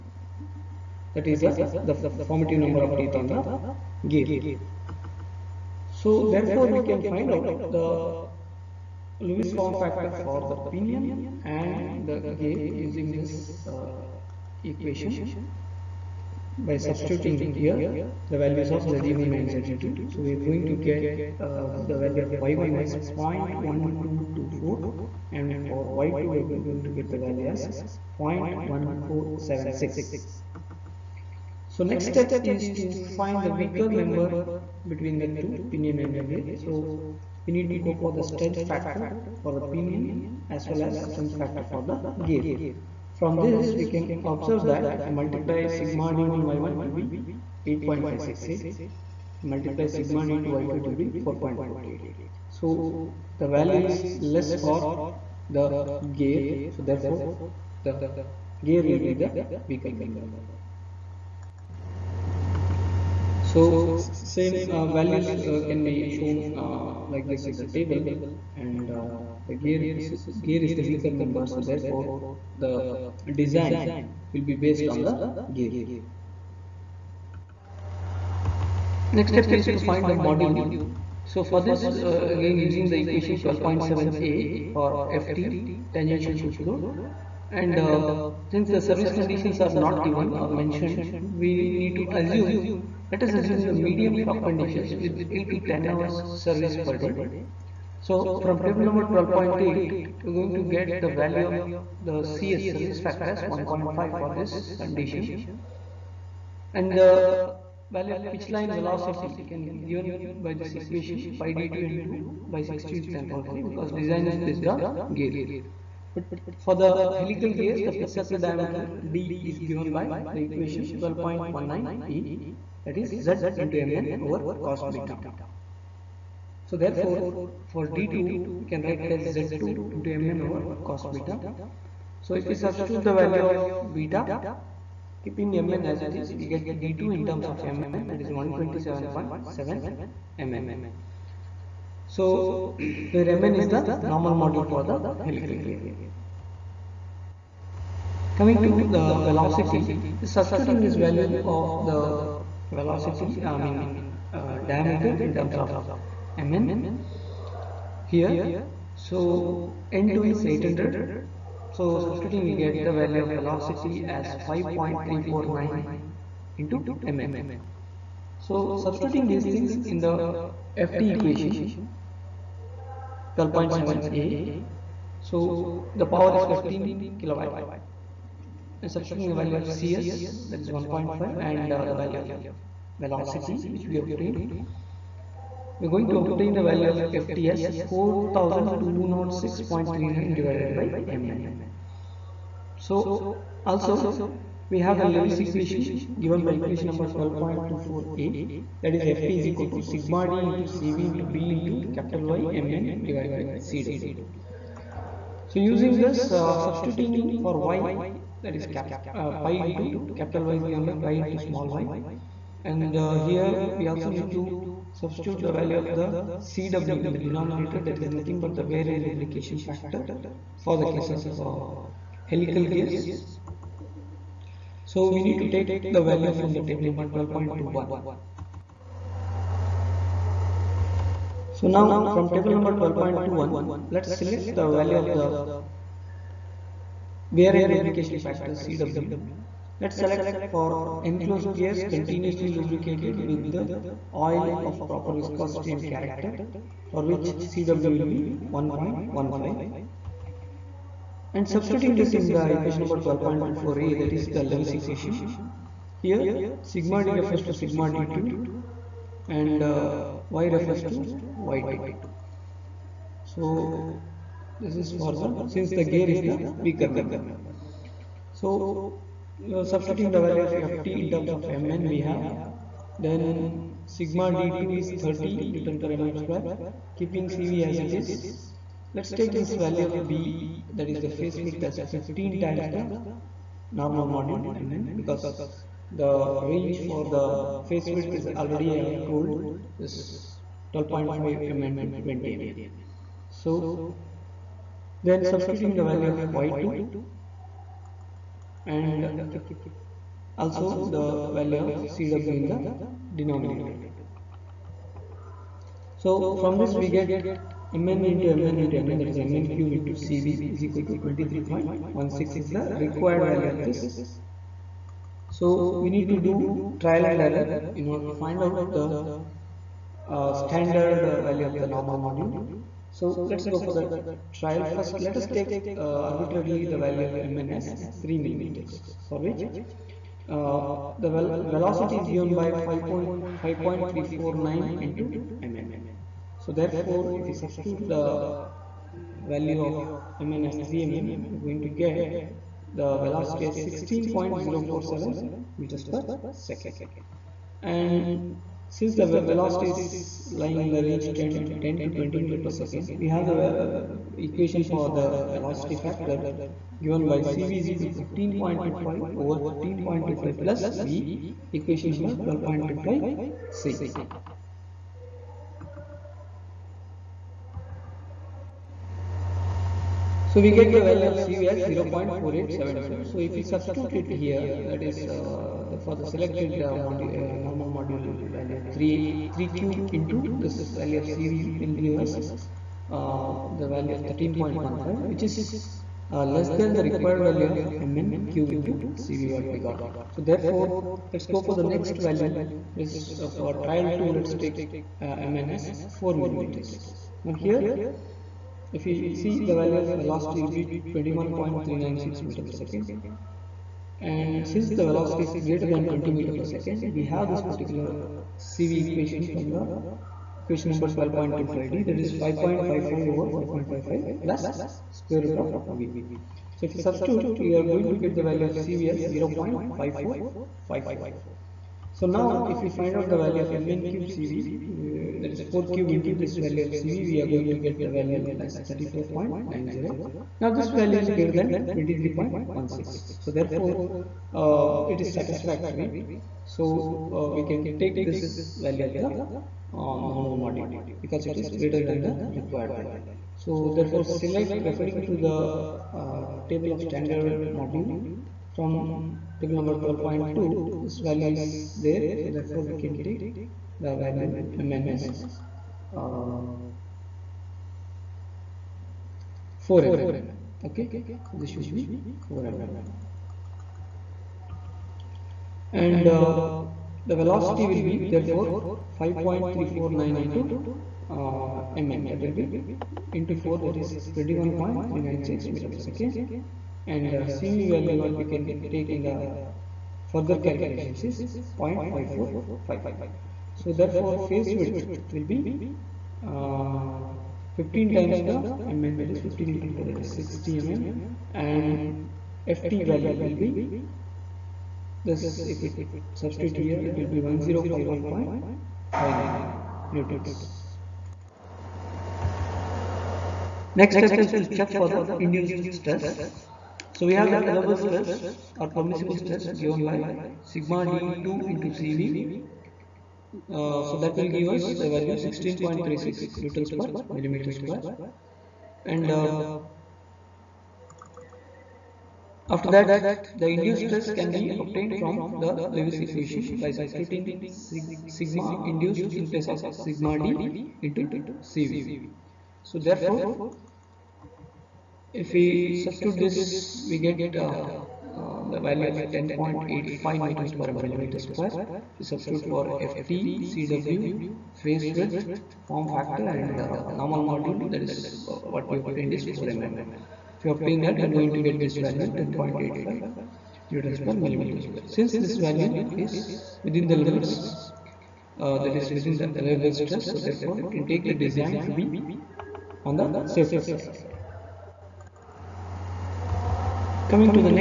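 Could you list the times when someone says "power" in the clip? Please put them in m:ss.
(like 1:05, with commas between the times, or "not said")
1:53, 2:56.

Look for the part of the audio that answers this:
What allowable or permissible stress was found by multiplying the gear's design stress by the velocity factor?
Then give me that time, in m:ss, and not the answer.
8:35.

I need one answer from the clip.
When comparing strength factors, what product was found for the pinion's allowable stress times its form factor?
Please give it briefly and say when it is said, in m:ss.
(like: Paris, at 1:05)
8.568, at 0:47.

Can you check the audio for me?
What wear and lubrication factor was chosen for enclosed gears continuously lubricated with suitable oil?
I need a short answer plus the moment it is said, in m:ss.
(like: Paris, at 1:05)
1.15, at 4:08.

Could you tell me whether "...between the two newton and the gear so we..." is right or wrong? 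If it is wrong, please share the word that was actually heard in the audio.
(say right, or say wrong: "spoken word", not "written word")
wrong: "pinion", not "newton".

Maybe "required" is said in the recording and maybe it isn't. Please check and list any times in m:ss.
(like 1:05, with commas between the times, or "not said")
5:12, 6:26, 7:22.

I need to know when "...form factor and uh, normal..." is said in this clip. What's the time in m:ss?
9:05.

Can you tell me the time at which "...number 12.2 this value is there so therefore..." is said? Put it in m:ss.
7:29.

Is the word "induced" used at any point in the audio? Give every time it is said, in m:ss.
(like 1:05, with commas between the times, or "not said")
8:25, 8:43, 8:48.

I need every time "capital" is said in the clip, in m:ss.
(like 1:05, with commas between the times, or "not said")
3:21, 3:30.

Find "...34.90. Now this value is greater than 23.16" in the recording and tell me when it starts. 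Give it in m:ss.
7:08.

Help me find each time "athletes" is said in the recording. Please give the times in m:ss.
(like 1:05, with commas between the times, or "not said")
not said.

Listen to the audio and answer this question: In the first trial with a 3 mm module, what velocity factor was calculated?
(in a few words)
0.4872.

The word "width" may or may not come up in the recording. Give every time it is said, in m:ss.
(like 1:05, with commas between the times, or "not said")
4:41, 4:47, 8:04, 9:04.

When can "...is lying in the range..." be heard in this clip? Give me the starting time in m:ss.
5:49.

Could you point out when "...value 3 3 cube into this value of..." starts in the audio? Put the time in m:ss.
6:18.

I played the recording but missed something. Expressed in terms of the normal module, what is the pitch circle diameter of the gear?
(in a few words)
127.7 mn.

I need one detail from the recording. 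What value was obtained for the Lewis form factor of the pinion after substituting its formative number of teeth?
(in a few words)
0.1224.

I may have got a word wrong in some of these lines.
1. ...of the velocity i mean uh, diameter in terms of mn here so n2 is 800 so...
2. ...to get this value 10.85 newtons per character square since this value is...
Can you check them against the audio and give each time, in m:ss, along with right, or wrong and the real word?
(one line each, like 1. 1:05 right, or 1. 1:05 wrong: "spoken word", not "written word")
1. 2:31 right
2. 9:11 wrong: "millimeter", not "character".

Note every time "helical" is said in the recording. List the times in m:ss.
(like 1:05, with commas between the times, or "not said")
1:57, 2:25, 3:42.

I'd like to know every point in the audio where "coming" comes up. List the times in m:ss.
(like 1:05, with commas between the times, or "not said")
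2:28, 9:27.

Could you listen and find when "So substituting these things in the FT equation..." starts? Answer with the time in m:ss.
2:48.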